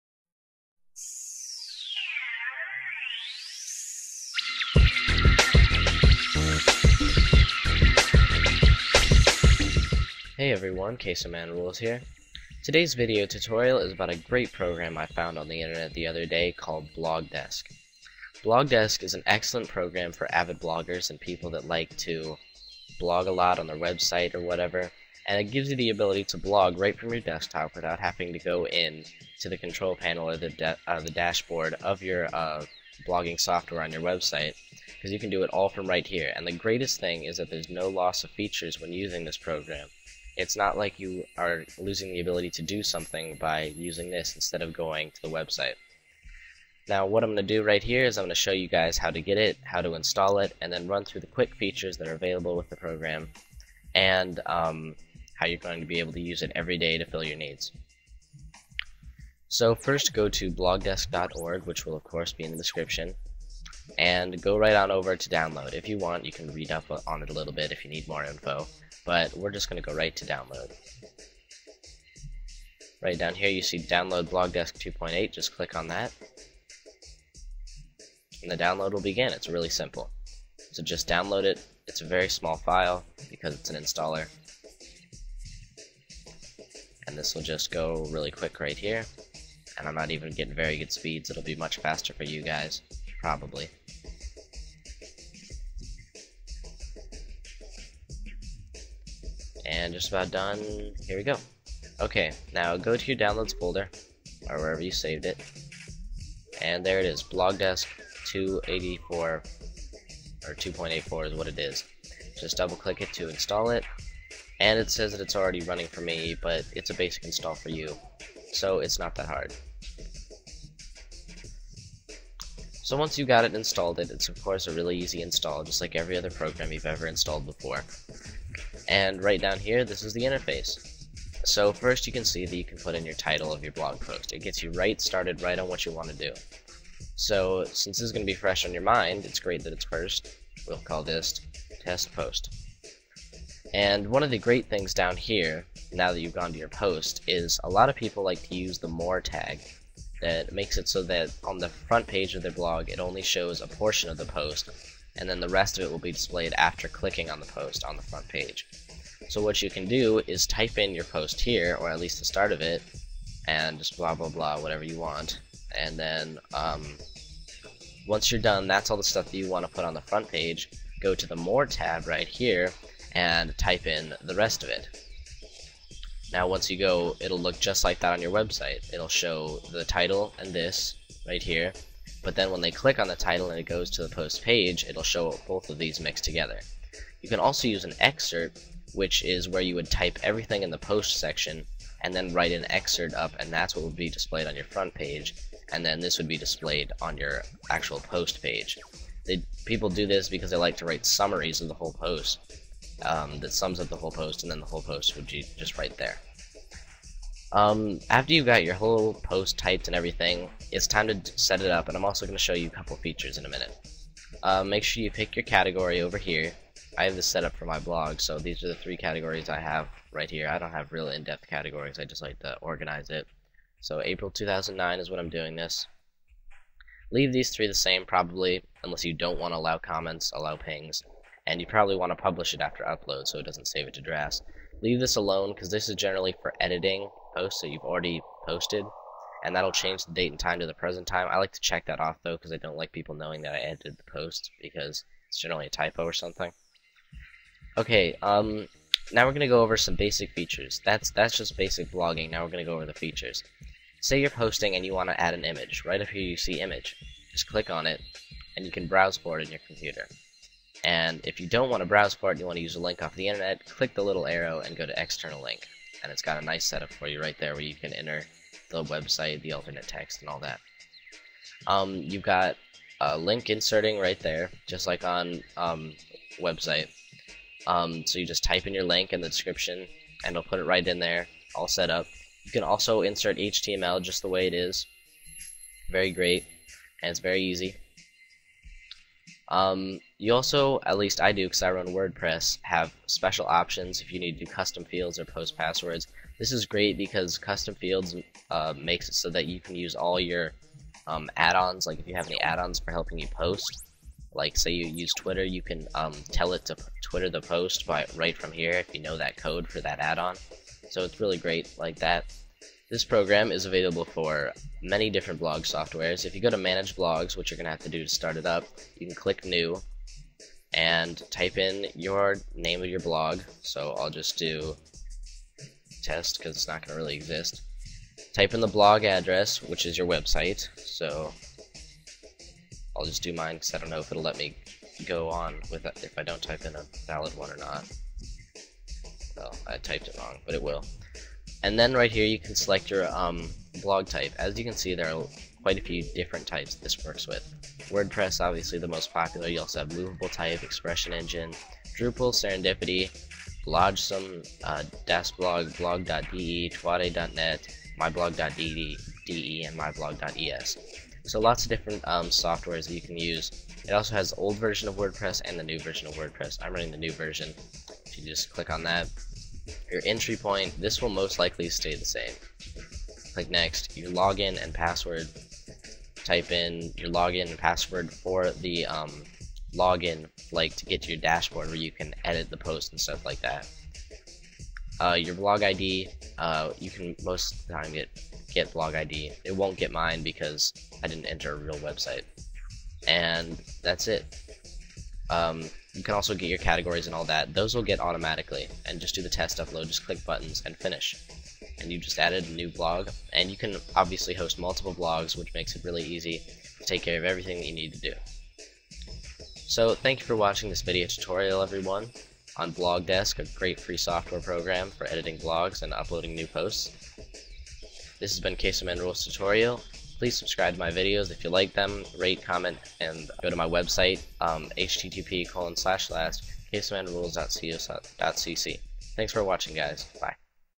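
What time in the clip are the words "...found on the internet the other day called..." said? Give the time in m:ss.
0:15.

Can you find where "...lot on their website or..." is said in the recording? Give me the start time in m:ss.
0:23.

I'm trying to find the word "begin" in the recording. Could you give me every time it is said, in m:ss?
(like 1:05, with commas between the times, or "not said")
1:19.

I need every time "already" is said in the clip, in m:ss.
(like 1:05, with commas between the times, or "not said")
1:55, 3:57.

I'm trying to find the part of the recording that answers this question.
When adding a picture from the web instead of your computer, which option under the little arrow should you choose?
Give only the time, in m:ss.
4:25.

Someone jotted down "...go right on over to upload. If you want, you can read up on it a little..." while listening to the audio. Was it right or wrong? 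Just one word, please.
wrong.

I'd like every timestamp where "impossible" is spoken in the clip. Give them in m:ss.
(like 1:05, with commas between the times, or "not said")
not said.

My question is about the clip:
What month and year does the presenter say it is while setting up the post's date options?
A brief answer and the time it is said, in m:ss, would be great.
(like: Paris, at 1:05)
April 2009, at 3:44.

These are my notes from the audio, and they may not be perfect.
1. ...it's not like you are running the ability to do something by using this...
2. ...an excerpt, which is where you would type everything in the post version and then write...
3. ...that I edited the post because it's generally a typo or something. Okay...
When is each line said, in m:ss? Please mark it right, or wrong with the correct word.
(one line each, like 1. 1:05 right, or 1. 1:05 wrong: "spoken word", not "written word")
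1. 0:40 wrong: "losing", not "running"
2. 3:07 wrong: "section", not "version"
3. 4:03 right.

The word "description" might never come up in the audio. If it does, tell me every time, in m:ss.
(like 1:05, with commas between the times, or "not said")
1:02, 4:39.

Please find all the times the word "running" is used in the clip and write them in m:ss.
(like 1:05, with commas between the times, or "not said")
1:55, 6:06.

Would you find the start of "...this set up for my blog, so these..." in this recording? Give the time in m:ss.
3:37.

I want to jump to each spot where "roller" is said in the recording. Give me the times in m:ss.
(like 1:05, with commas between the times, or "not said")
not said.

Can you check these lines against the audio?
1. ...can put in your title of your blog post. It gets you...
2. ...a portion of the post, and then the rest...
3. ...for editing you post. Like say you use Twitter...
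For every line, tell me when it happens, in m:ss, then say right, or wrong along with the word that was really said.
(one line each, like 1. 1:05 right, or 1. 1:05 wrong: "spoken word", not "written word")
1. 2:12 right
2. 2:33 right
3. 5:02 wrong: "helping", not "editing".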